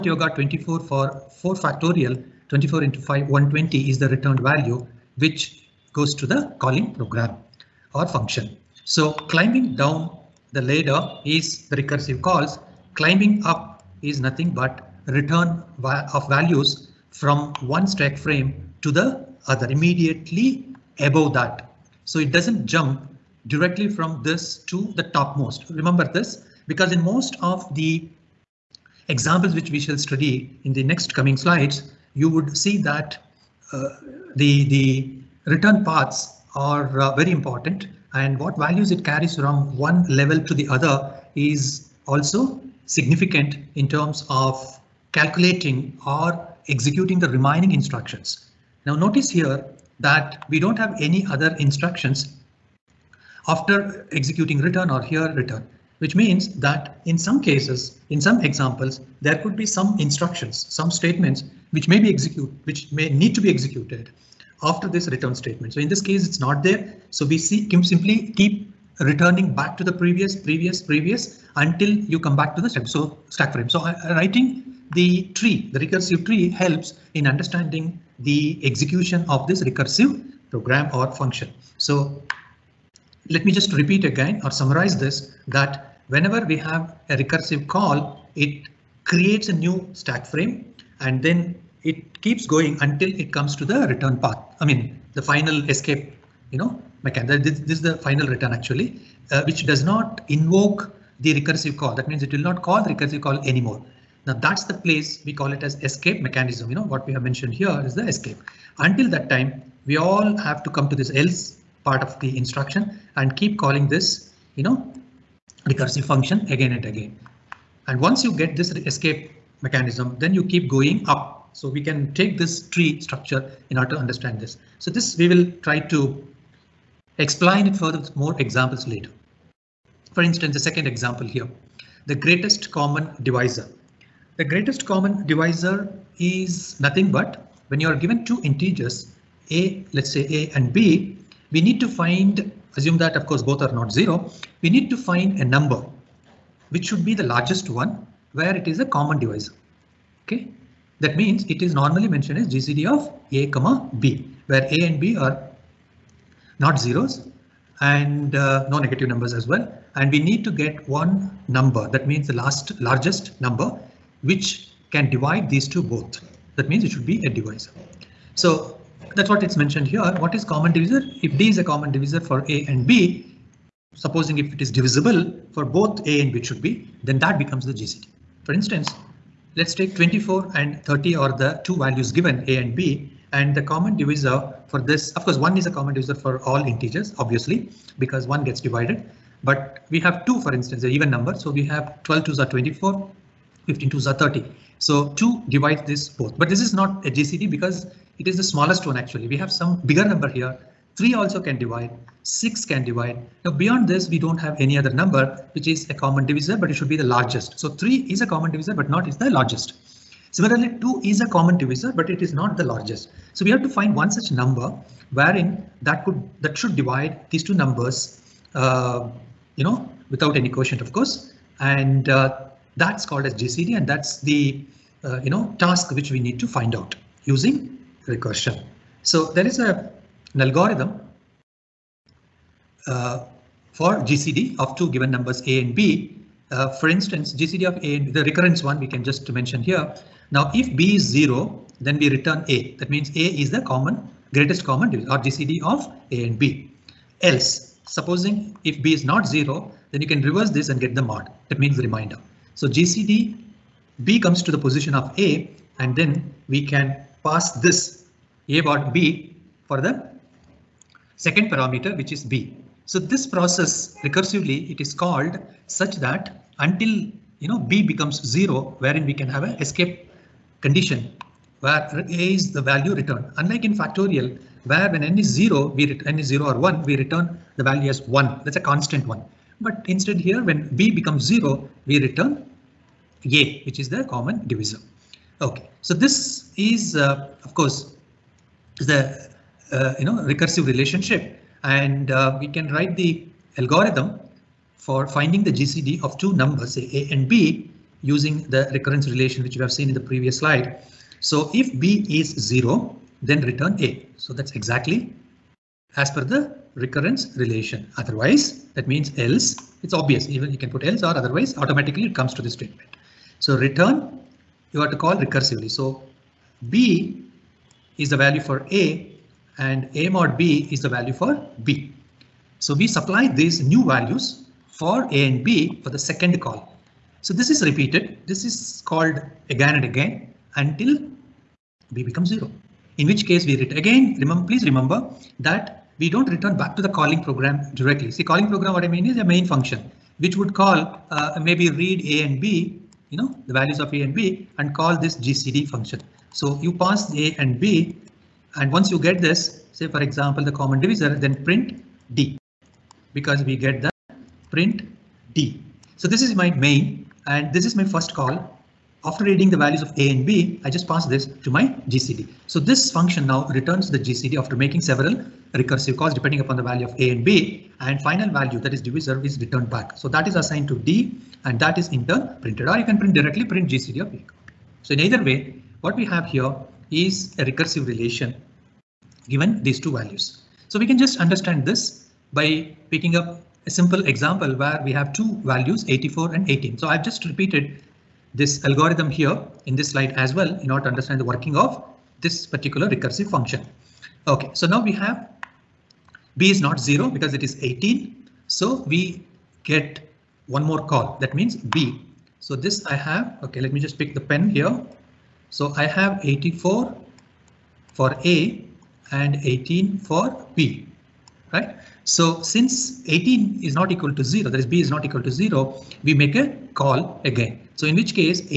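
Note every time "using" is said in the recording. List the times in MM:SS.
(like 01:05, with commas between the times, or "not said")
03:47, 04:58.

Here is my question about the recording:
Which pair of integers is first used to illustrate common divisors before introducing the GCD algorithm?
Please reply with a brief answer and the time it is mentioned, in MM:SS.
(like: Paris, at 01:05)
24 and 30, at 02:59.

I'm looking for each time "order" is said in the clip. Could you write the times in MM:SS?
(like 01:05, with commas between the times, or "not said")
02:03, 06:30.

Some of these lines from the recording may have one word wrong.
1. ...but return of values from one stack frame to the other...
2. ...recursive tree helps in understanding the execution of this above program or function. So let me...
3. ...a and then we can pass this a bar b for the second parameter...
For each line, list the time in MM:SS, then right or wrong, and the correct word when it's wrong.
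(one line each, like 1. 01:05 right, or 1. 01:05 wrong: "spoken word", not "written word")
1. 00:14 right
2. 01:15 wrong: "recursive", not "above"
3. 04:15 right.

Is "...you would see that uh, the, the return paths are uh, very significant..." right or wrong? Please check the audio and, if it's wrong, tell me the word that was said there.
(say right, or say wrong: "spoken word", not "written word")
wrong: "important", not "significant".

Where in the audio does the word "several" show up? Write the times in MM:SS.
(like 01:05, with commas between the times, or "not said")
06:04.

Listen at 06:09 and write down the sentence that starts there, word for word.
So that is assigned to d and that is in turn printed or you can print directly print GCD of a.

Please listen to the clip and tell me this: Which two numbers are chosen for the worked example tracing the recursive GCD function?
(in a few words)
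84 and 18.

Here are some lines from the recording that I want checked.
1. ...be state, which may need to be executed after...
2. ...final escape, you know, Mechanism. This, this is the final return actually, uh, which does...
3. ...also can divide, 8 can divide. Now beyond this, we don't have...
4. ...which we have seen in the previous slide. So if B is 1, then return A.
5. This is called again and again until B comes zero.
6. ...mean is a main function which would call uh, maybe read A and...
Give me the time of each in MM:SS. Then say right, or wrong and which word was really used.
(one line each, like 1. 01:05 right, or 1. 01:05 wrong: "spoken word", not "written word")
1. 01:01 wrong: "execute", not "state"
2. 01:35 right
3. 03:21 wrong: "6", not "8"
4. 04:59 wrong: "0", not "1"
5. 05:28 wrong: "becomes", not "comes"
6. 05:38 right.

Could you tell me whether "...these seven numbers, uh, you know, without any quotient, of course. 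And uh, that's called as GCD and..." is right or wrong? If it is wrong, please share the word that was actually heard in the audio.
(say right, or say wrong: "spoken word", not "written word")
wrong: "two", not "seven".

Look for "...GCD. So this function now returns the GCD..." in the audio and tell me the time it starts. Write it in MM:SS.
06:01.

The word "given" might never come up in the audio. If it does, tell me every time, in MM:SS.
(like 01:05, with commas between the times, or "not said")
02:17, 03:02, 03:54, 06:19.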